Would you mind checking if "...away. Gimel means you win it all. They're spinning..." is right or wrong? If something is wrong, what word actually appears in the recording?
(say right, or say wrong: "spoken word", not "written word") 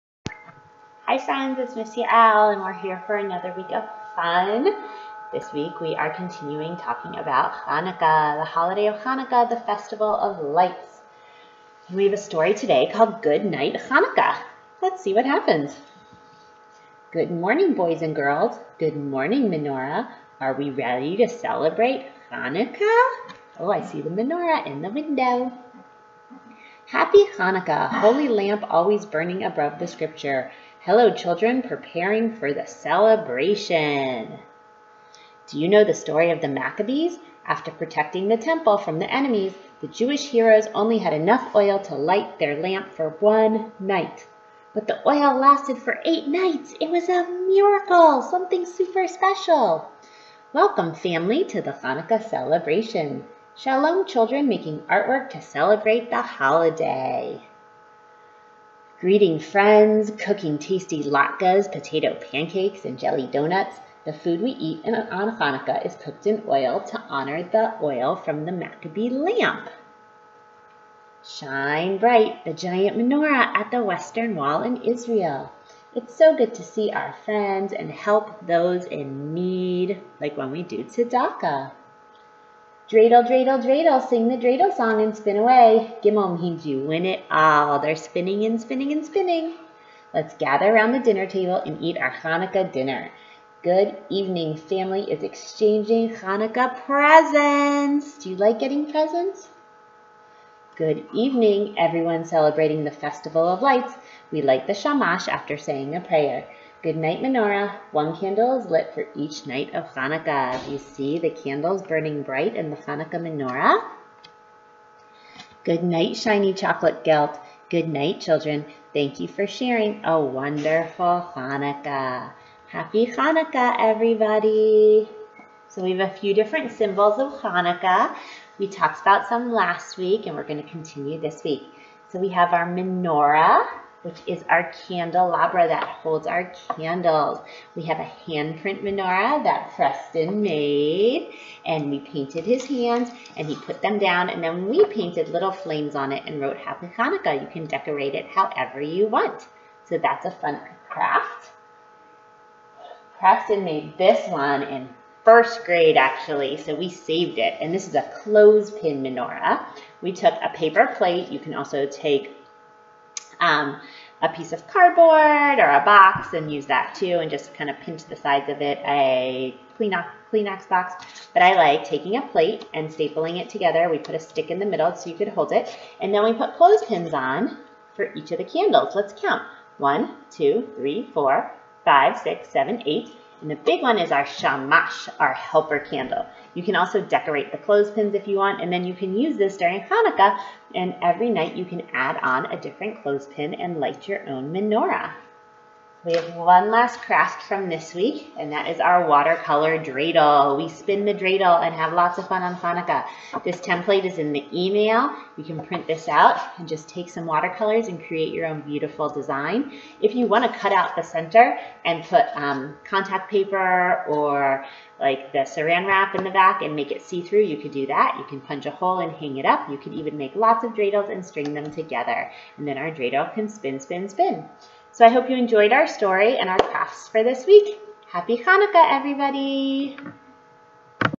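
right.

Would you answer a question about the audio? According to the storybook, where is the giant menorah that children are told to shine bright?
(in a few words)
Western Wall in Israel.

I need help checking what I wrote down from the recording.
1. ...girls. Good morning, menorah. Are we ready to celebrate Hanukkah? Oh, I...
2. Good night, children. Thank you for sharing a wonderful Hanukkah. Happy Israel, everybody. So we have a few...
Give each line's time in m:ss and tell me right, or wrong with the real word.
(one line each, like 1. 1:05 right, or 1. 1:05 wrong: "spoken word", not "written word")
1. 0:18 right
2. 1:57 wrong: "Hanukkah", not "Israel".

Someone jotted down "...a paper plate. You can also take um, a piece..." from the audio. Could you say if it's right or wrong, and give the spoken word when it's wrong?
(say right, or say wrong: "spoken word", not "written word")
right.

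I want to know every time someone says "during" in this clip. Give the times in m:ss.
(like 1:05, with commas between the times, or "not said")
3:09.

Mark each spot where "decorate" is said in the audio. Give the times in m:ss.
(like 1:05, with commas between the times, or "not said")
2:27, 3:07.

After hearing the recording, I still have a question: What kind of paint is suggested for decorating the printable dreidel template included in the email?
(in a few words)
watercolors.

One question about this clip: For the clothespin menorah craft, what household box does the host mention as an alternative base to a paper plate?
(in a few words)
Kleenex box.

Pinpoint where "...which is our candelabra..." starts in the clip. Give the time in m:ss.
2:14.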